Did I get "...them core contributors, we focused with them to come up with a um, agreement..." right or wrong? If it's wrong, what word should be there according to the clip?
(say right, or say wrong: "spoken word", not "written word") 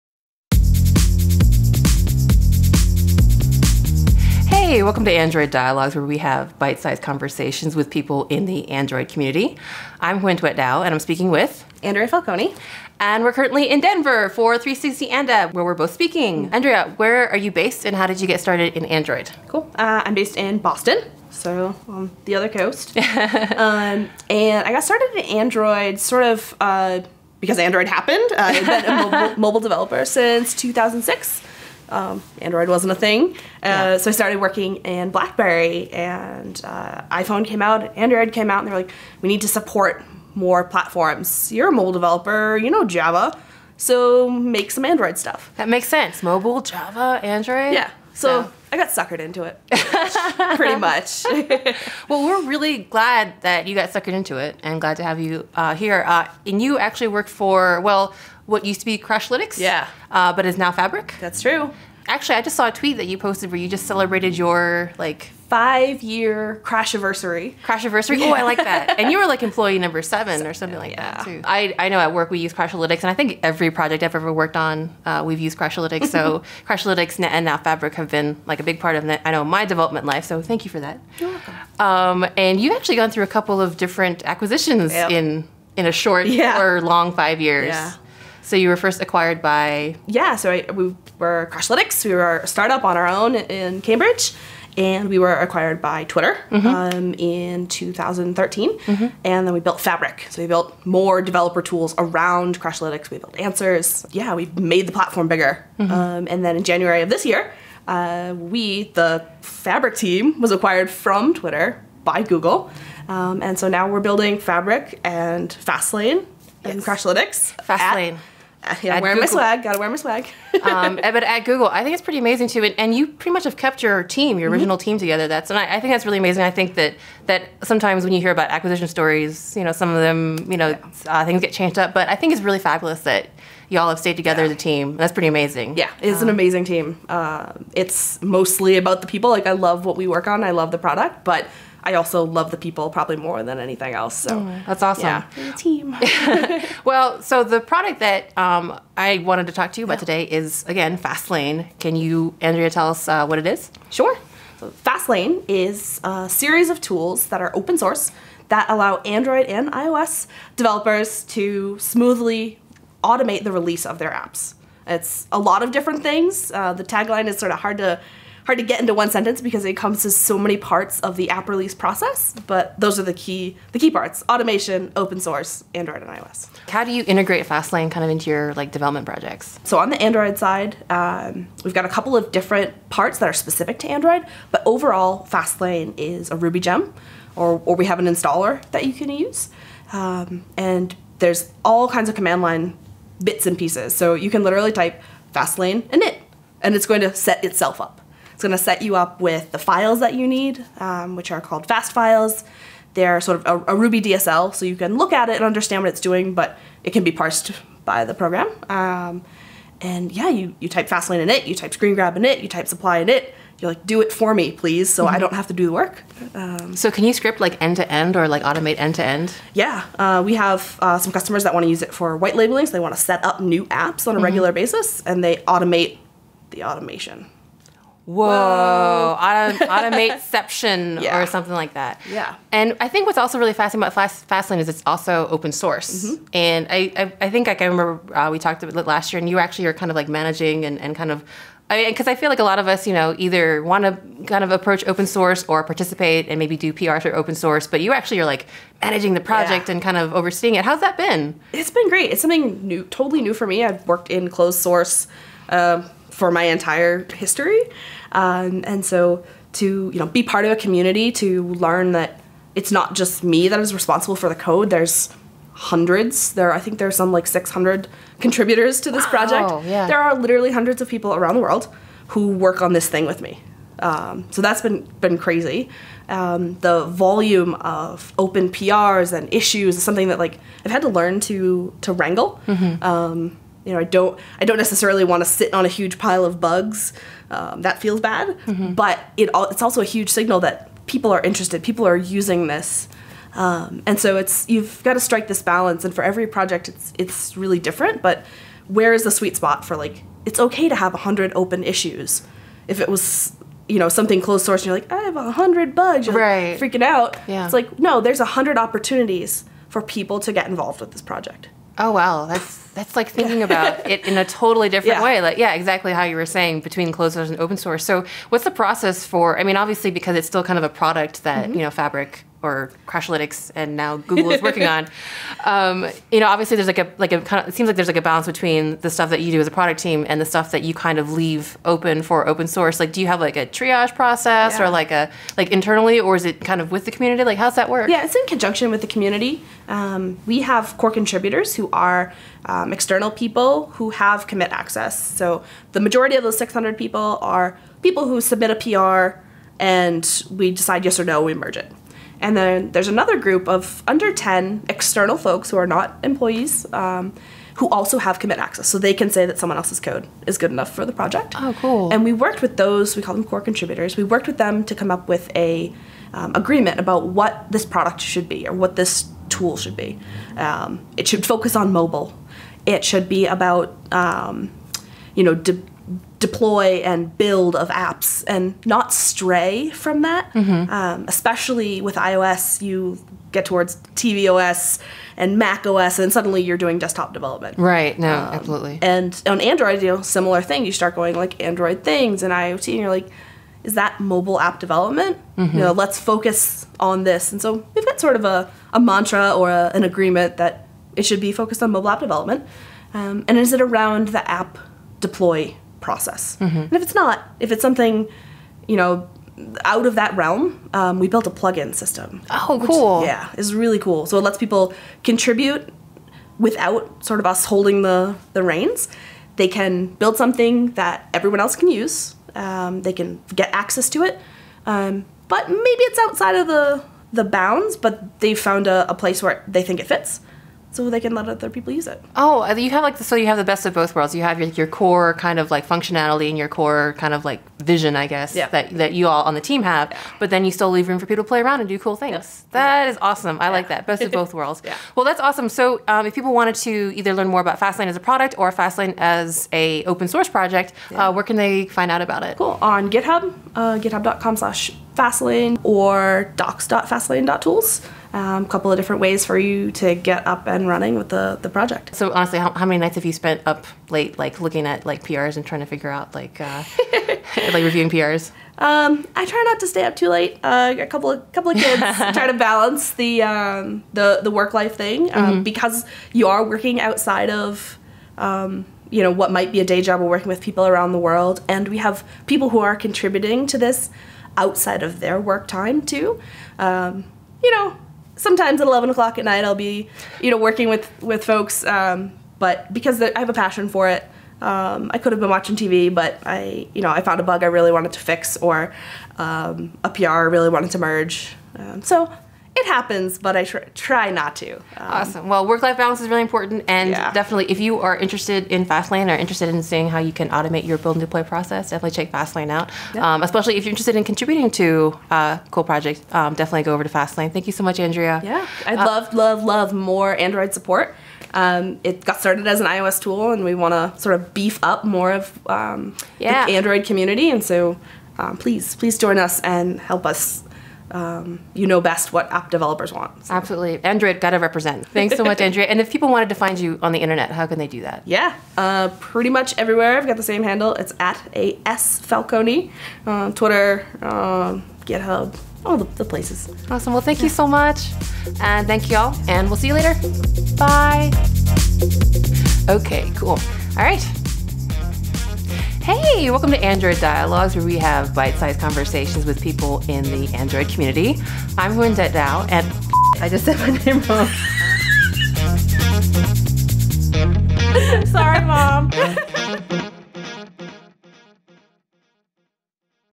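wrong: "worked", not "focused".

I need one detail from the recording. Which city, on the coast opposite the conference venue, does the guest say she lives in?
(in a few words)
Boston.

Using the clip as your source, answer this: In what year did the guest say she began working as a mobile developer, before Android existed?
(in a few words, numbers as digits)
2006.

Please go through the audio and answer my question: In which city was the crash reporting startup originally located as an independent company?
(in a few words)
Cambridge.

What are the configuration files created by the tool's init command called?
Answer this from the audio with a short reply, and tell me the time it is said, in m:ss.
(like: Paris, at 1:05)
Fastfiles, at 3:21.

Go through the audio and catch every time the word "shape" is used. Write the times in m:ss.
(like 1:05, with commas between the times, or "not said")
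not said.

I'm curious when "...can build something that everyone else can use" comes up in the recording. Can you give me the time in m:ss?
6:59.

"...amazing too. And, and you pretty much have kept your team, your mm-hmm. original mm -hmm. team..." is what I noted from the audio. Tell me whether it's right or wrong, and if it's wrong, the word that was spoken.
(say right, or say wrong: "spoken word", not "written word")
right.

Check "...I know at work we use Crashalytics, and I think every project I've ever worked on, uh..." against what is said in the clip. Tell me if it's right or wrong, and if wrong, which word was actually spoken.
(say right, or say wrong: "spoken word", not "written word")
right.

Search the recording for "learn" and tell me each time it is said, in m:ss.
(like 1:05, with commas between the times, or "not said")
4:21, 4:40, 7:27.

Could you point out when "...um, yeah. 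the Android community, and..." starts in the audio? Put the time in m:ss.
8:45.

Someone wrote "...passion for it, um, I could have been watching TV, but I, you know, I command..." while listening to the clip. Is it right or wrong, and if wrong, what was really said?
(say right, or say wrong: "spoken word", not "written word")
wrong: "found", not "command".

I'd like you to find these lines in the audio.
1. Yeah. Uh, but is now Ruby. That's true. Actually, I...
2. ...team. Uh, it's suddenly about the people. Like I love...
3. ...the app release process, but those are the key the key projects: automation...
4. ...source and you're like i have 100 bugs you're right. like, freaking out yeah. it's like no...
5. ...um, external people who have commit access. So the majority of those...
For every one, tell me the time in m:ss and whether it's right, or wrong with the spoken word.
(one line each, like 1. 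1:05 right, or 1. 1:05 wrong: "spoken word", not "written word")
1. 0:59 wrong: "Fabric", not "Ruby"
2. 2:16 wrong: "mostly", not "suddenly"
3. 2:51 wrong: "parts", not "projects"
4. 5:04 right
5. 5:42 right.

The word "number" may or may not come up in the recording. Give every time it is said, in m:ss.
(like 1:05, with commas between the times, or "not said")
1:09.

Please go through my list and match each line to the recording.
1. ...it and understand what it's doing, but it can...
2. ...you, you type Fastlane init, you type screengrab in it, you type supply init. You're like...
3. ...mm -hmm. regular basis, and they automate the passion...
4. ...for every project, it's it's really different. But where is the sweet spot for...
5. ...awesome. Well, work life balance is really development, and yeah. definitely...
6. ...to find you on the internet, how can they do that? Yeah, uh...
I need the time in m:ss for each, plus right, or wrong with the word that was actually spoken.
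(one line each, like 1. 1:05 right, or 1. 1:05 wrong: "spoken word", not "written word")
1. 3:25 right
2. 3:30 right
3. 3:44 wrong: "automation", not "passion"
4. 4:55 right
5. 8:24 wrong: "important", not "development"
6. 8:56 right.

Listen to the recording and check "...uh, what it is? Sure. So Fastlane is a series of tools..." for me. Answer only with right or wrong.
right.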